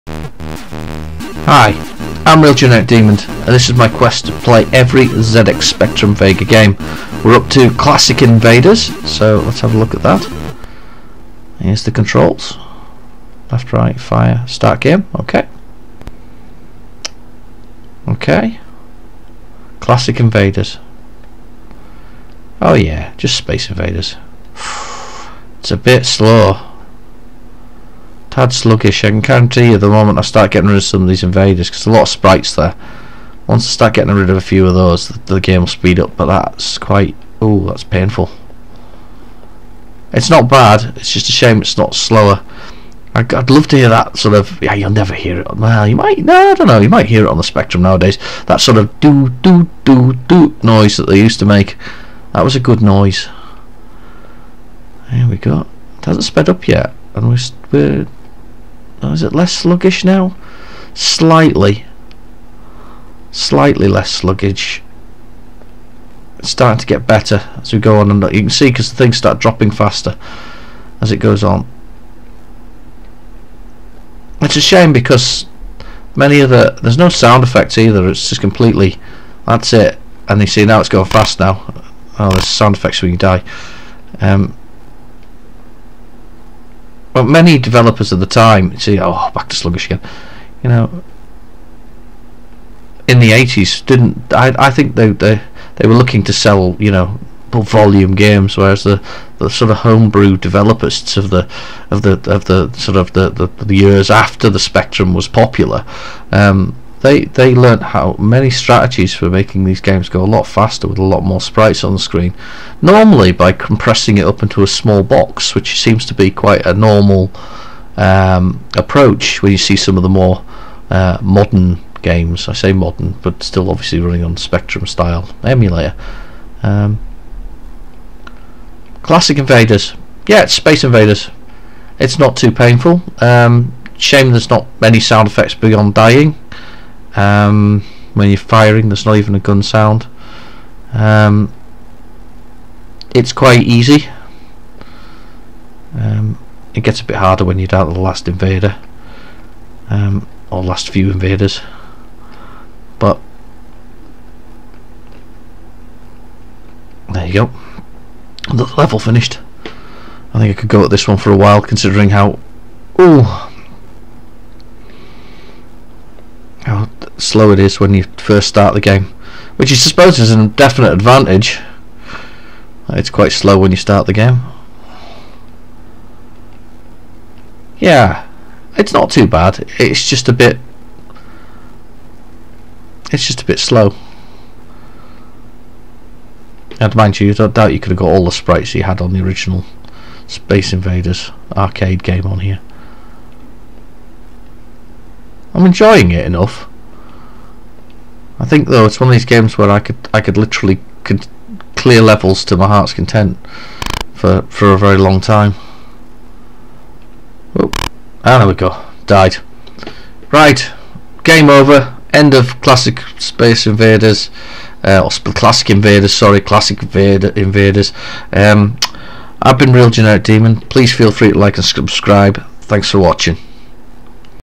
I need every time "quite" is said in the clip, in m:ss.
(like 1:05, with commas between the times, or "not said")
0:36, 1:56, 2:23, 2:53.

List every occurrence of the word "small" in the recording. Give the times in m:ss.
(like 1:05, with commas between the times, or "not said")
1:54.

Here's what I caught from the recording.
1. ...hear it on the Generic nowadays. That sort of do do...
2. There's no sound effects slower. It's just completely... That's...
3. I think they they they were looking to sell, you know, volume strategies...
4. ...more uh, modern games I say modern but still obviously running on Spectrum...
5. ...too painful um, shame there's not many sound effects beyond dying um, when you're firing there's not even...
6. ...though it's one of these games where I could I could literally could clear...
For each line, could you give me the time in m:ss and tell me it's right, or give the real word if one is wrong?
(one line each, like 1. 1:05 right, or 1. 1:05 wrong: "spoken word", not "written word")
1. 0:47 wrong: "Spectrum", not "Generic"
2. 1:16 wrong: "either", not "slower"
3. 1:34 wrong: "games", not "strategies"
4. 2:00 right
5. 2:12 right
6. 3:18 right.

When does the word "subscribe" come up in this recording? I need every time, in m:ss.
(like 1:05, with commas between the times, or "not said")
3:41.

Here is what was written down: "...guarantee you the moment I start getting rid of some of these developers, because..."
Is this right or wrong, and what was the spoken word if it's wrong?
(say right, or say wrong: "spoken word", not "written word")
wrong: "invaders", not "developers".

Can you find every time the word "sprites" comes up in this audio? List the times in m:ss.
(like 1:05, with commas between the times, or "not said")
0:32, 1:51, 3:08.